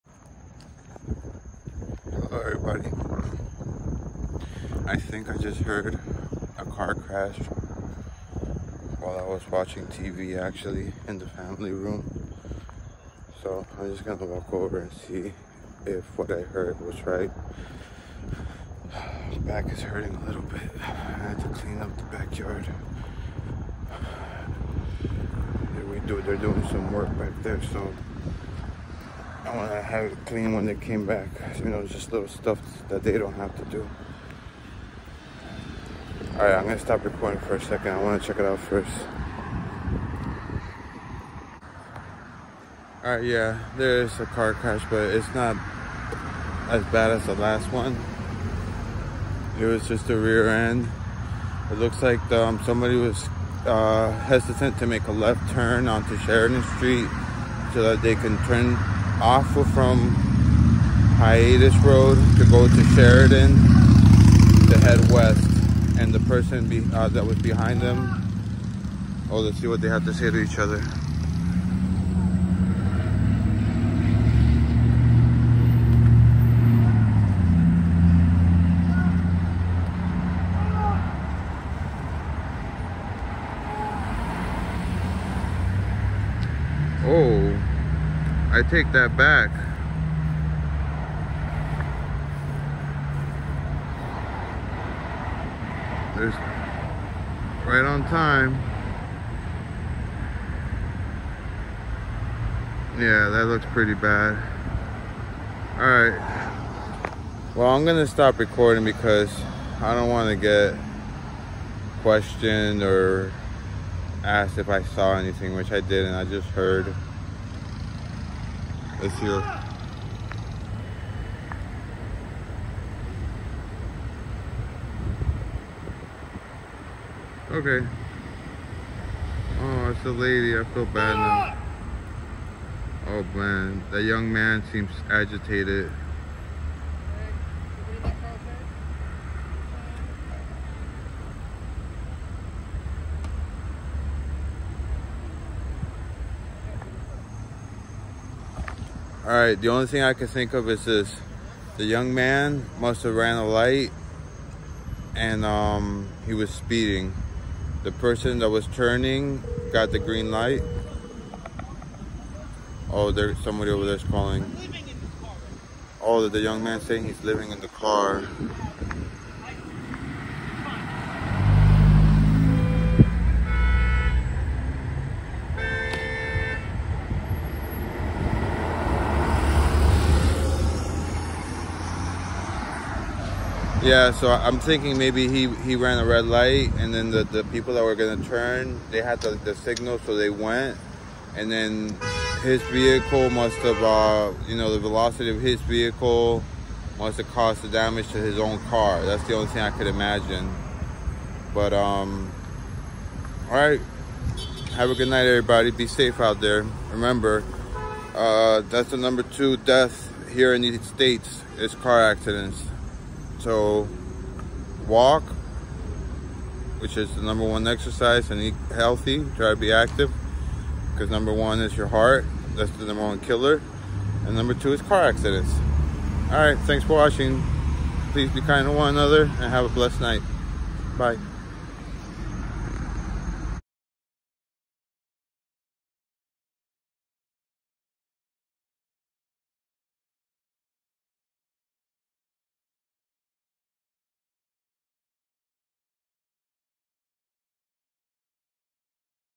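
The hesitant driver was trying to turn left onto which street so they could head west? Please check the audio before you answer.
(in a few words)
Sheridan Street.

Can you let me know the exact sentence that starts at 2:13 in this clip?
Oh man, that young man seems agitated.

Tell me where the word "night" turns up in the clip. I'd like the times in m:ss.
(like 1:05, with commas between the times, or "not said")
3:25, 3:50.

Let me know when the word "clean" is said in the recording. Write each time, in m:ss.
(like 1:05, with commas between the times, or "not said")
0:21, 0:30.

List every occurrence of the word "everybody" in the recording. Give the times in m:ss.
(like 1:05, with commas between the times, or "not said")
0:02, 3:25.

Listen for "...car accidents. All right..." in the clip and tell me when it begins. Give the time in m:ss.
3:44.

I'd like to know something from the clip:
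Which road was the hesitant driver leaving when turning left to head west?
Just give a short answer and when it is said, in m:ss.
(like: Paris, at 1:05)
Hiatus Road, at 1:01.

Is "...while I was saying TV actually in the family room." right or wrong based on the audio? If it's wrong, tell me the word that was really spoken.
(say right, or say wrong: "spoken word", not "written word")
wrong: "watching", not "saying".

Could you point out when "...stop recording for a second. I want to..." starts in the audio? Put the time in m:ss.
0:36.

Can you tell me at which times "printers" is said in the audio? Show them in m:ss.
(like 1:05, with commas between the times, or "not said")
not said.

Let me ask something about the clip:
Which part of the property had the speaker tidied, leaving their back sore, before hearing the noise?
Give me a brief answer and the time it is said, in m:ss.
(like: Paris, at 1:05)
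backyard, at 0:22.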